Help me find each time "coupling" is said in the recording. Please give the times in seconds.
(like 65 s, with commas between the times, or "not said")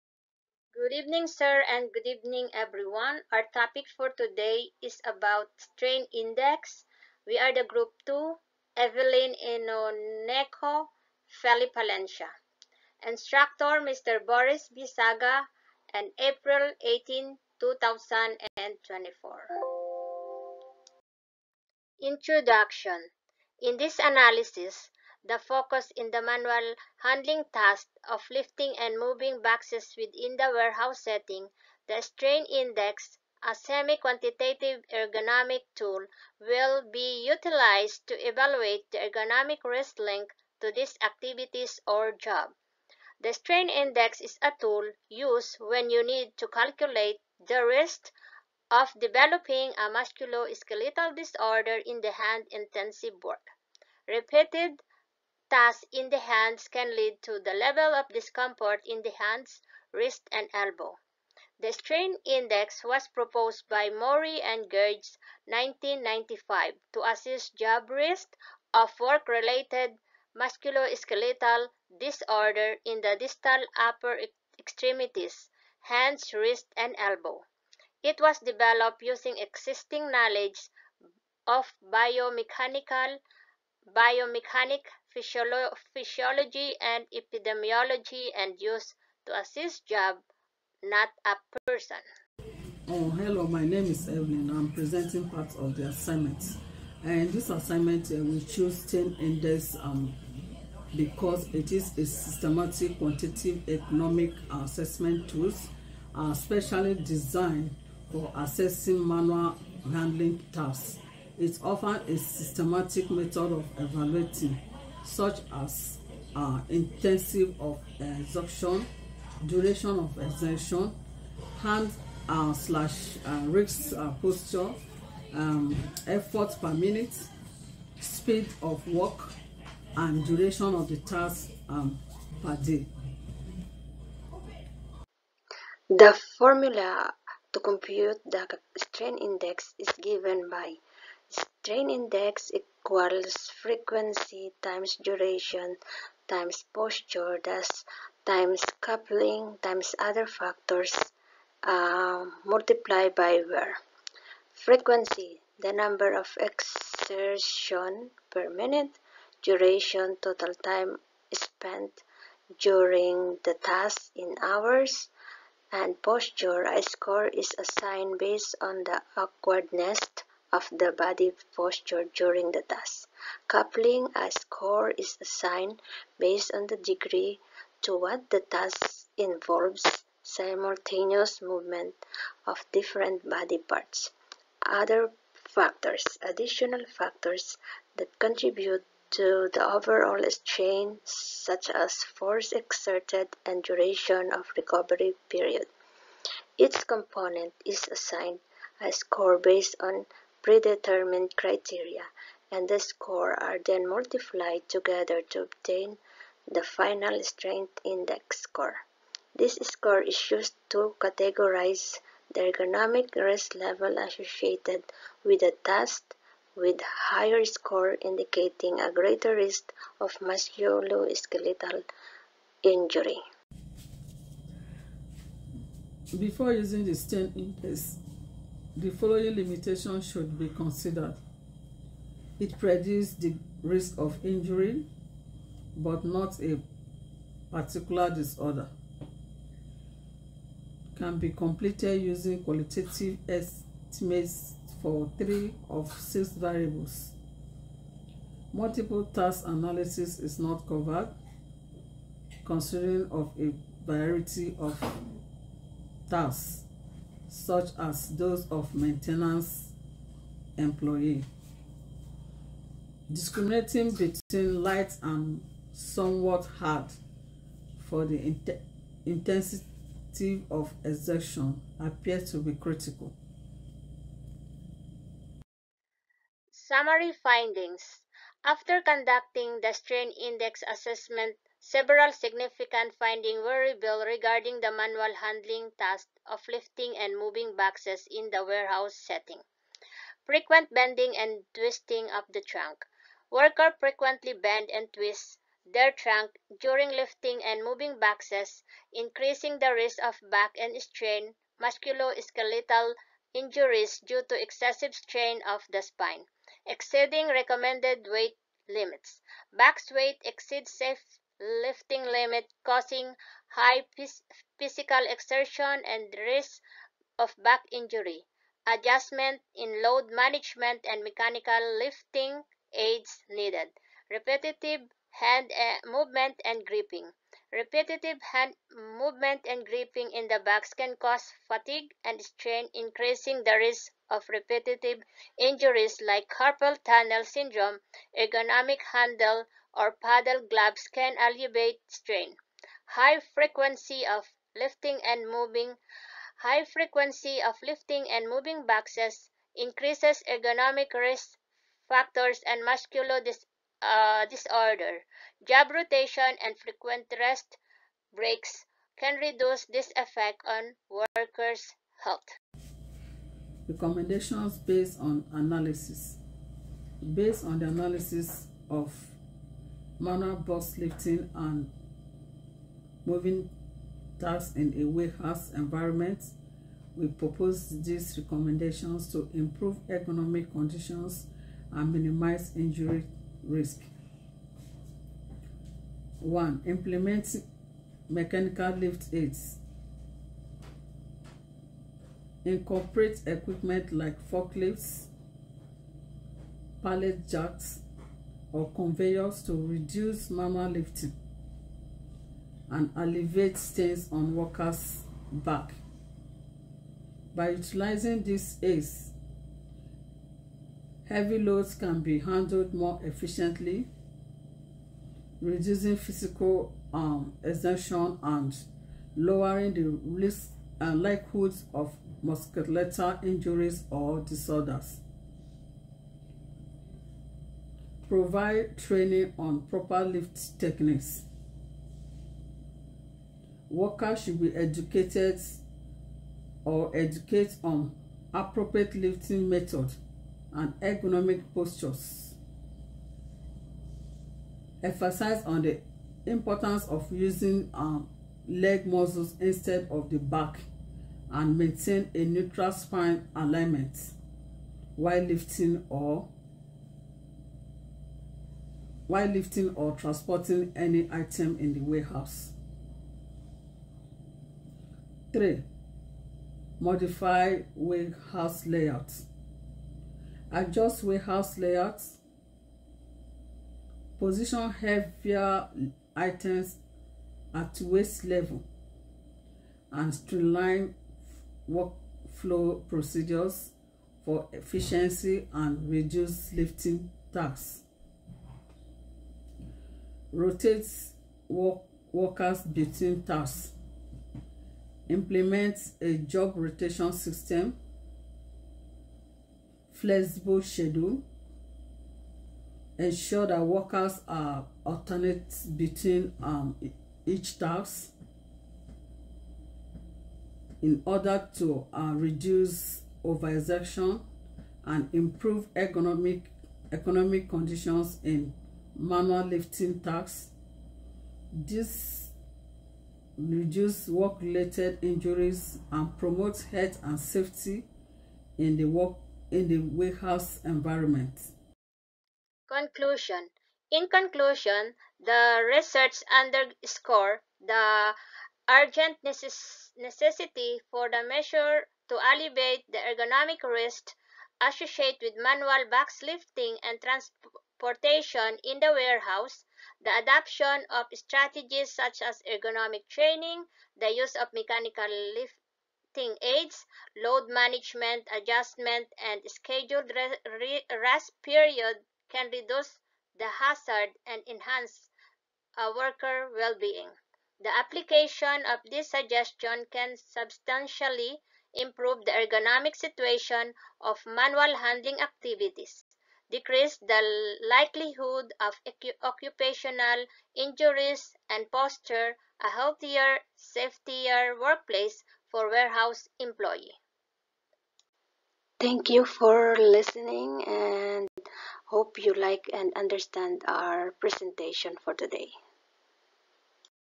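148 s, 173 s.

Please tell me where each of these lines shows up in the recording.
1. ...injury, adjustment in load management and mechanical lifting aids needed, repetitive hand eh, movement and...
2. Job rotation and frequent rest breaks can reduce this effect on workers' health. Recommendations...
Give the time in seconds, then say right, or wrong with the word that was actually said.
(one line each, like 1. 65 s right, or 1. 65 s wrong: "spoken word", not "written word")
1. 317 s right
2. 355 s right.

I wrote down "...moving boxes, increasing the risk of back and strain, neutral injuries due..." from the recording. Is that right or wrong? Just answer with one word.
wrong.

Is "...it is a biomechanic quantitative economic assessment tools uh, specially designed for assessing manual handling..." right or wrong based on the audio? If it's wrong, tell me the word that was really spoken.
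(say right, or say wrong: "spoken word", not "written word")
wrong: "systematic", not "biomechanic".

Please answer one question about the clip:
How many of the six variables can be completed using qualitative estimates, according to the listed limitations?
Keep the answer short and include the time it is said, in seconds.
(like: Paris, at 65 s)
3, at 245 s.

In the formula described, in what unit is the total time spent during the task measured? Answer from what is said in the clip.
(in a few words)
Hours.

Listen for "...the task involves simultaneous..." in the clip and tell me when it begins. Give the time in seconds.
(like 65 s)
178 s.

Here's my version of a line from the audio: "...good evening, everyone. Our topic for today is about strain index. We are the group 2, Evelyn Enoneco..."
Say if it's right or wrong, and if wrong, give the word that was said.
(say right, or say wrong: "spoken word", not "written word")
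right.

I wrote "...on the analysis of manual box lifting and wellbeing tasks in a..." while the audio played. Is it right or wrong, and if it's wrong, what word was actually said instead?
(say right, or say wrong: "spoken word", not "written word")
wrong: "moving", not "wellbeing".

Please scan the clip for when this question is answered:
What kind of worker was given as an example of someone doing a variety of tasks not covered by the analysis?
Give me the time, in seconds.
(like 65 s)
258 s.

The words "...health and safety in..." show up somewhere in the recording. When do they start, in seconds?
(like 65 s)
526 s.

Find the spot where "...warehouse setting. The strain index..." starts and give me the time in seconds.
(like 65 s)
30 s.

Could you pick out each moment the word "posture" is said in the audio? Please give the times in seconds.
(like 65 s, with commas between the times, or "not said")
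124 s, 146 s, 166 s, 171 s, 441 s, 581 s.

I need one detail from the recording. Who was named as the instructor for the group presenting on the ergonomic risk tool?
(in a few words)
Boris Bisaga.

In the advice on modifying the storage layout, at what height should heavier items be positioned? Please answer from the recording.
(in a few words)
Waist level.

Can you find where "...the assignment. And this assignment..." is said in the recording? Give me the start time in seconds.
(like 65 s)
95 s.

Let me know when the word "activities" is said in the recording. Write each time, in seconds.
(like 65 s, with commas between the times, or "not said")
41 s, 575 s.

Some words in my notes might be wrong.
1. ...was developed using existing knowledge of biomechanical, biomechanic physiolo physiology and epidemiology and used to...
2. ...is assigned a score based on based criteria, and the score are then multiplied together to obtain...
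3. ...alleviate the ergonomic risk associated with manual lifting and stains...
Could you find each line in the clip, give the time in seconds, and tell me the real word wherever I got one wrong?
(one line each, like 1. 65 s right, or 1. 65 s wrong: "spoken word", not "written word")
1. 78 s right
2. 197 s wrong: "predetermined", not "based"
3. 542 s wrong: "trans", not "stains".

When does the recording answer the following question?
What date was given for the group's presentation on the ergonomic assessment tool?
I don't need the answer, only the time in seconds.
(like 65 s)
16 s.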